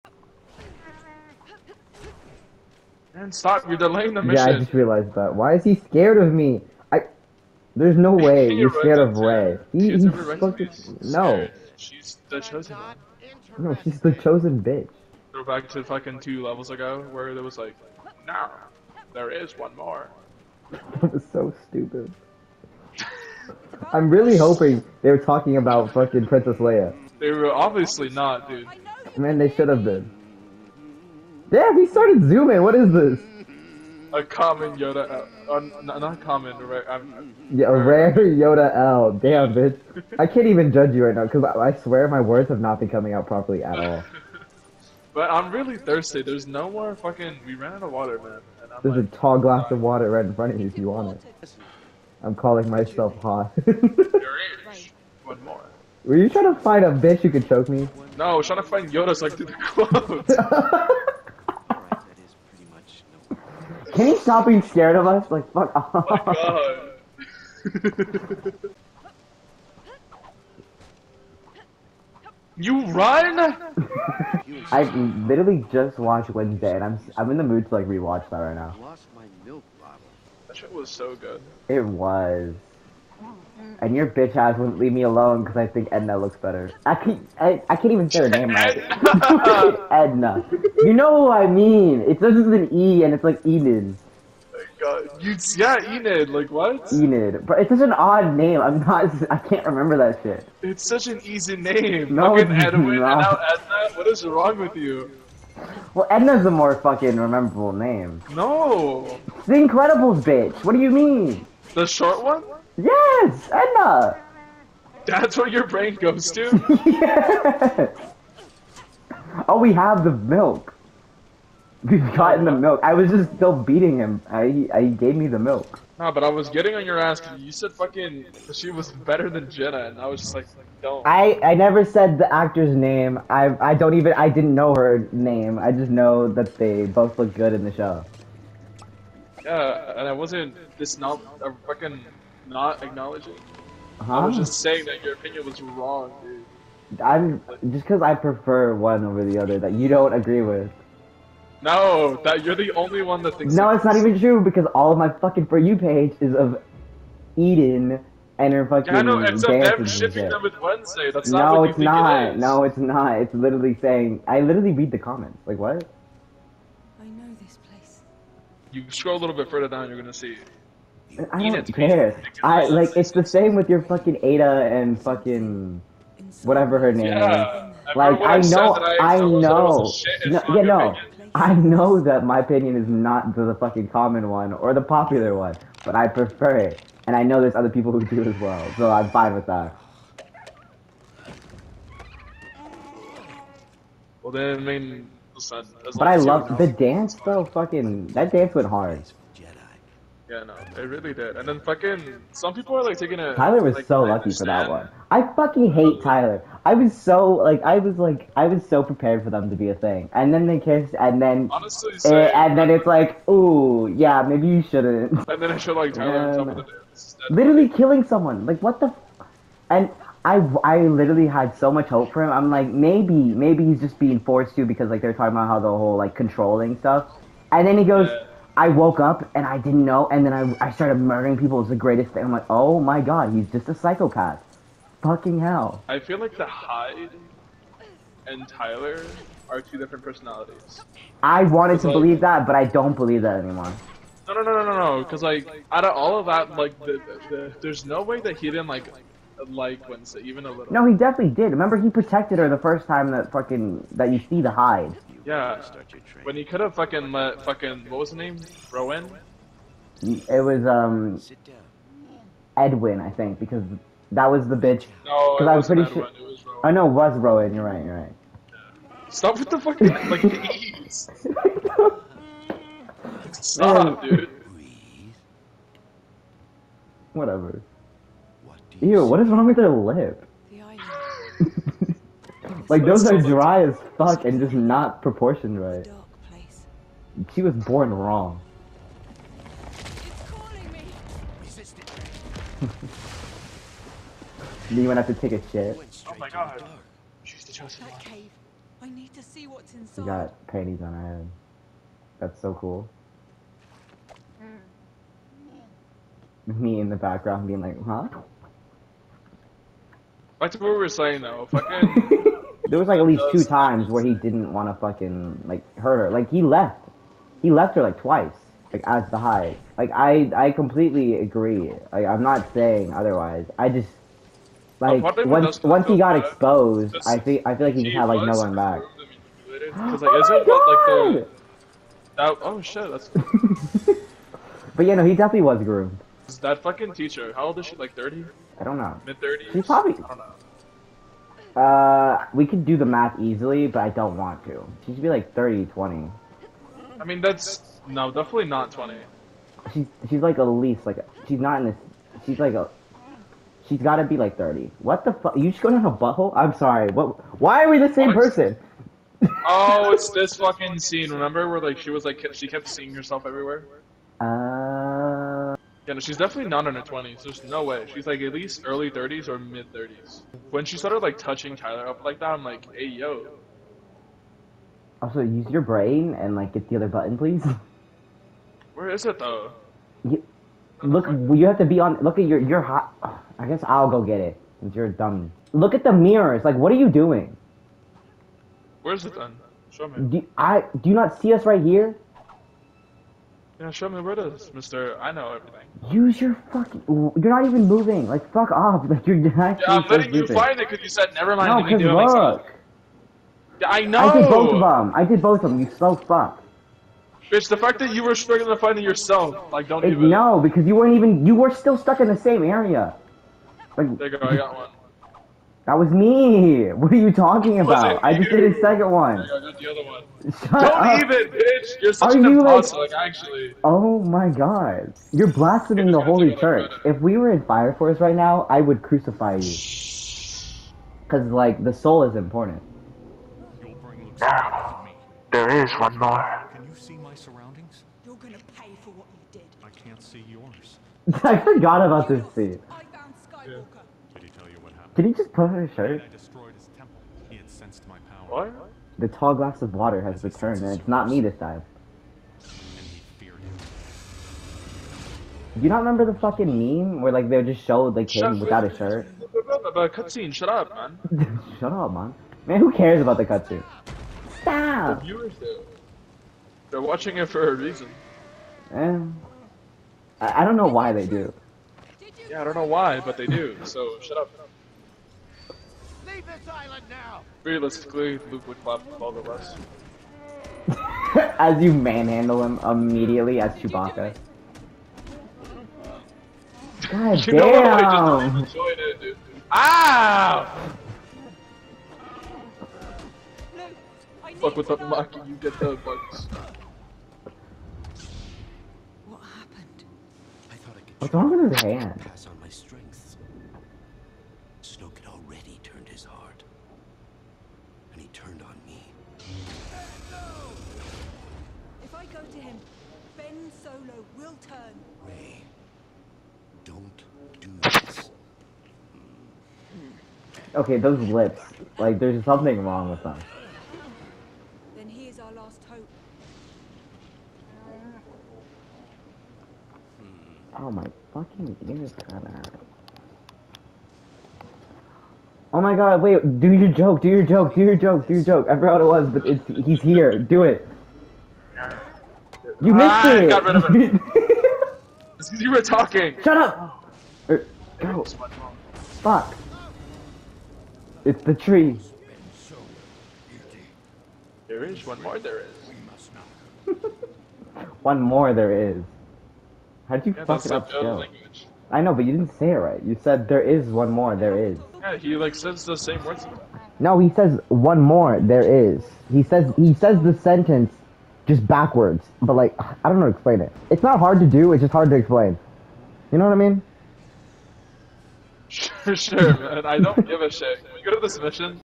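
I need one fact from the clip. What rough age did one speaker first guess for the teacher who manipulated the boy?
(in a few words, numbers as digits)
Thirty.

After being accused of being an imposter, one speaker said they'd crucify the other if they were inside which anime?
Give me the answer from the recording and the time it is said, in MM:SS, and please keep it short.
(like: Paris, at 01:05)
Fire Force, at 07:07.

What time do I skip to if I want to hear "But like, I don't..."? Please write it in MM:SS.
09:32.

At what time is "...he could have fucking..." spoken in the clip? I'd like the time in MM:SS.
04:16.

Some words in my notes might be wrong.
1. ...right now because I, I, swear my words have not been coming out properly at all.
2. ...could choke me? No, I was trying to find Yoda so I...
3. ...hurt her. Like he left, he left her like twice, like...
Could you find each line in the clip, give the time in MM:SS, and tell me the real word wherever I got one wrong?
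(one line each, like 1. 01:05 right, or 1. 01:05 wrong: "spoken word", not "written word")
1. 00:41 right
2. 00:57 right
3. 05:15 right.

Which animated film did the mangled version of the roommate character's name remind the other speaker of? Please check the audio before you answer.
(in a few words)
The Incredibles.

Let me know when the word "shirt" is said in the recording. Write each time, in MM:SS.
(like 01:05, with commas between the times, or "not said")
07:25, 07:38.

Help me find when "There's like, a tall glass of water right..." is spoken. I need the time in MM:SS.
00:48.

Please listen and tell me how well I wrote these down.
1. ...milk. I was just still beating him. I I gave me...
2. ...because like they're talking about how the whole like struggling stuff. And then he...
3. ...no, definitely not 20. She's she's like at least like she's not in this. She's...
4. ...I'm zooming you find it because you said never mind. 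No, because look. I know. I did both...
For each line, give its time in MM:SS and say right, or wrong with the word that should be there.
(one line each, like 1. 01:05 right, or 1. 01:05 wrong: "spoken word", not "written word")
1. 02:02 right
2. 03:44 wrong: "controlling", not "struggling"
3. 05:47 right
4. 06:39 wrong: "letting", not "zooming".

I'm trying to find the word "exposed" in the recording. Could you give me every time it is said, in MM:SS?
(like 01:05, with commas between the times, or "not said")
05:26.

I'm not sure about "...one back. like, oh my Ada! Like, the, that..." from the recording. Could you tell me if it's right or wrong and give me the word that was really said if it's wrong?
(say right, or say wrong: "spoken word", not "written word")
wrong: "God", not "Ada".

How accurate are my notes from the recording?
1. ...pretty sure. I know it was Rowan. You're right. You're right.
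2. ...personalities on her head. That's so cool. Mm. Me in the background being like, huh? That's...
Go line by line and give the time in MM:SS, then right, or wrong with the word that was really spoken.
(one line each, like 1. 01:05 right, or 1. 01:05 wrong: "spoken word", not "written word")
1. 04:25 right
2. 05:00 wrong: "panties", not "personalities".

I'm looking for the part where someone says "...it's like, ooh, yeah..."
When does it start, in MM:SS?
03:32.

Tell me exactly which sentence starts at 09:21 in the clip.
I know, but you didn't say it right.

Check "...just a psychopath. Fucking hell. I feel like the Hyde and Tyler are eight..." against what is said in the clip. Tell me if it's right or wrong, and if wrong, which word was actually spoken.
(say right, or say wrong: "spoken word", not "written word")
wrong: "two", not "eight".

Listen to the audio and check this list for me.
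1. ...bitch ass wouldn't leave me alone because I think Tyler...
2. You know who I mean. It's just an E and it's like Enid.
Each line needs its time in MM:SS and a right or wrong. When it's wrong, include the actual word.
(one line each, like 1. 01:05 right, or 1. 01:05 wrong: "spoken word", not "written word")
1. 01:24 wrong: "Edna", not "Tyler"
2. 01:30 right.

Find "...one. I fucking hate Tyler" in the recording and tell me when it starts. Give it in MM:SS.
03:24.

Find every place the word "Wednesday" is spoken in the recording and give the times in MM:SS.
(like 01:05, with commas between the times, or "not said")
01:16, 02:40, 04:09.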